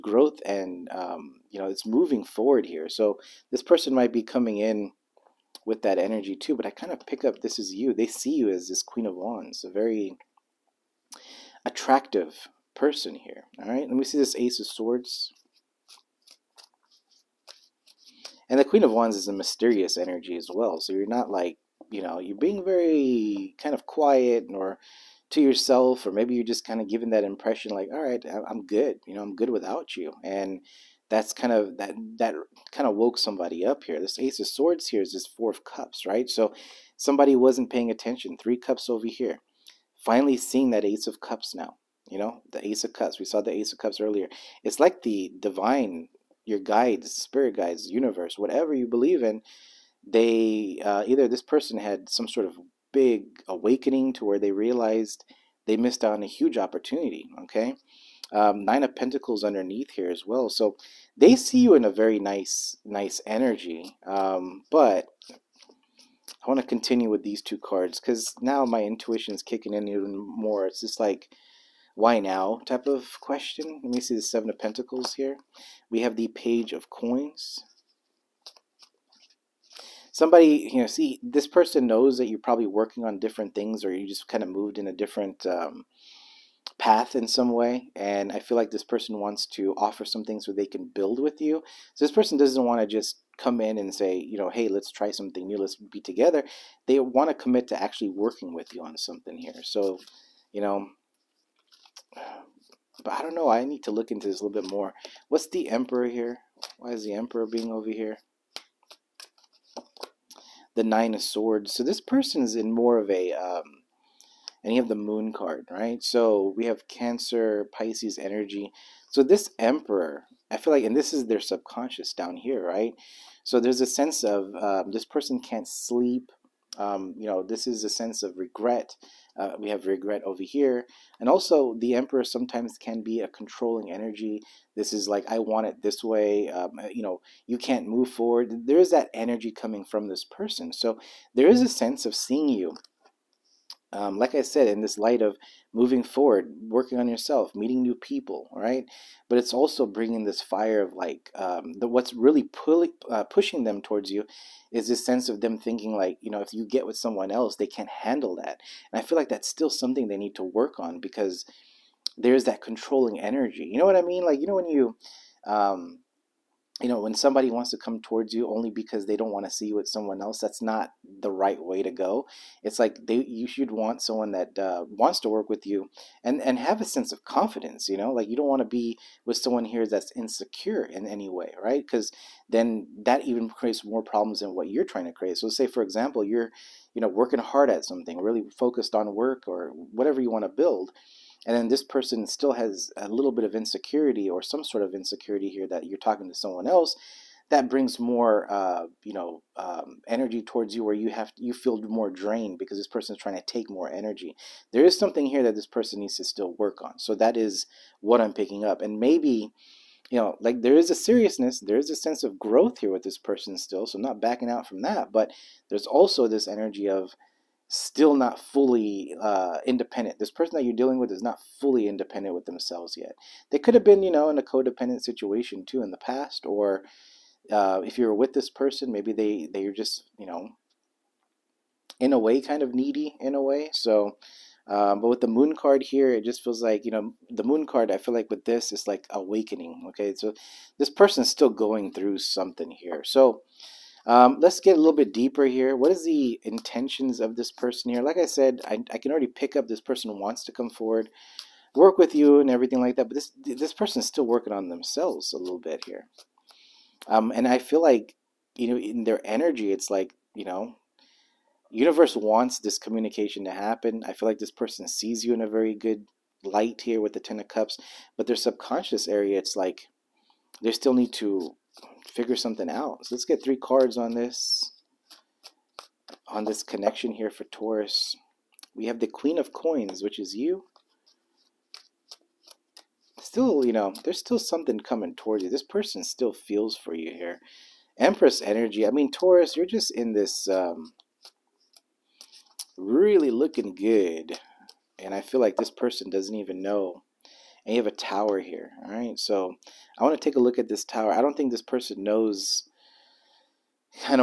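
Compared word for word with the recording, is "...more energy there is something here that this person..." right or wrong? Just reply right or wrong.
right.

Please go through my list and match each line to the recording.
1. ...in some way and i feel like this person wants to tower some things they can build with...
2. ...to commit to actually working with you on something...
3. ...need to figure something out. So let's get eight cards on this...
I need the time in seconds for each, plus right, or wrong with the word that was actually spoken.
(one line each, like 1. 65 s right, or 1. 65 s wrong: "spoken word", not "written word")
1. 87 s wrong: "offer", not "tower"
2. 97 s right
3. 270 s wrong: "three", not "eight".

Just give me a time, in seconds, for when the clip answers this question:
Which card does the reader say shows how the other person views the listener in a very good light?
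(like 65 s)
267 s.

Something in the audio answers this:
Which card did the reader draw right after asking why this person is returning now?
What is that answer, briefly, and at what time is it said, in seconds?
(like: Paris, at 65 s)
Seven of Pentacles, at 74 s.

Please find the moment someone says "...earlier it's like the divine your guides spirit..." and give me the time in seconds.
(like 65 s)
43 s.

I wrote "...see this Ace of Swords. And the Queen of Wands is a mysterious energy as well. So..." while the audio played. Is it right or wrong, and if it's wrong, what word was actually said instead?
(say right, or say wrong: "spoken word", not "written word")
right.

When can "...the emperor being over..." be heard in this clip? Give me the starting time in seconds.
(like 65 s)
107 s.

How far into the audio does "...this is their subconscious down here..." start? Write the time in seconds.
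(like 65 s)
120 s.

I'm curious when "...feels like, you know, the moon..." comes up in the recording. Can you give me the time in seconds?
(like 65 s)
236 s.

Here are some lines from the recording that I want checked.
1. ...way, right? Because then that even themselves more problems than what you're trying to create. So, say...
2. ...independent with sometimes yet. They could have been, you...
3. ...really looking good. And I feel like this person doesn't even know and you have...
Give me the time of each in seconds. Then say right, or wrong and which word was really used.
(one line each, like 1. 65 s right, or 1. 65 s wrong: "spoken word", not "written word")
1. 181 s wrong: "creates", not "themselves"
2. 221 s wrong: "themselves", not "sometimes"
3. 292 s right.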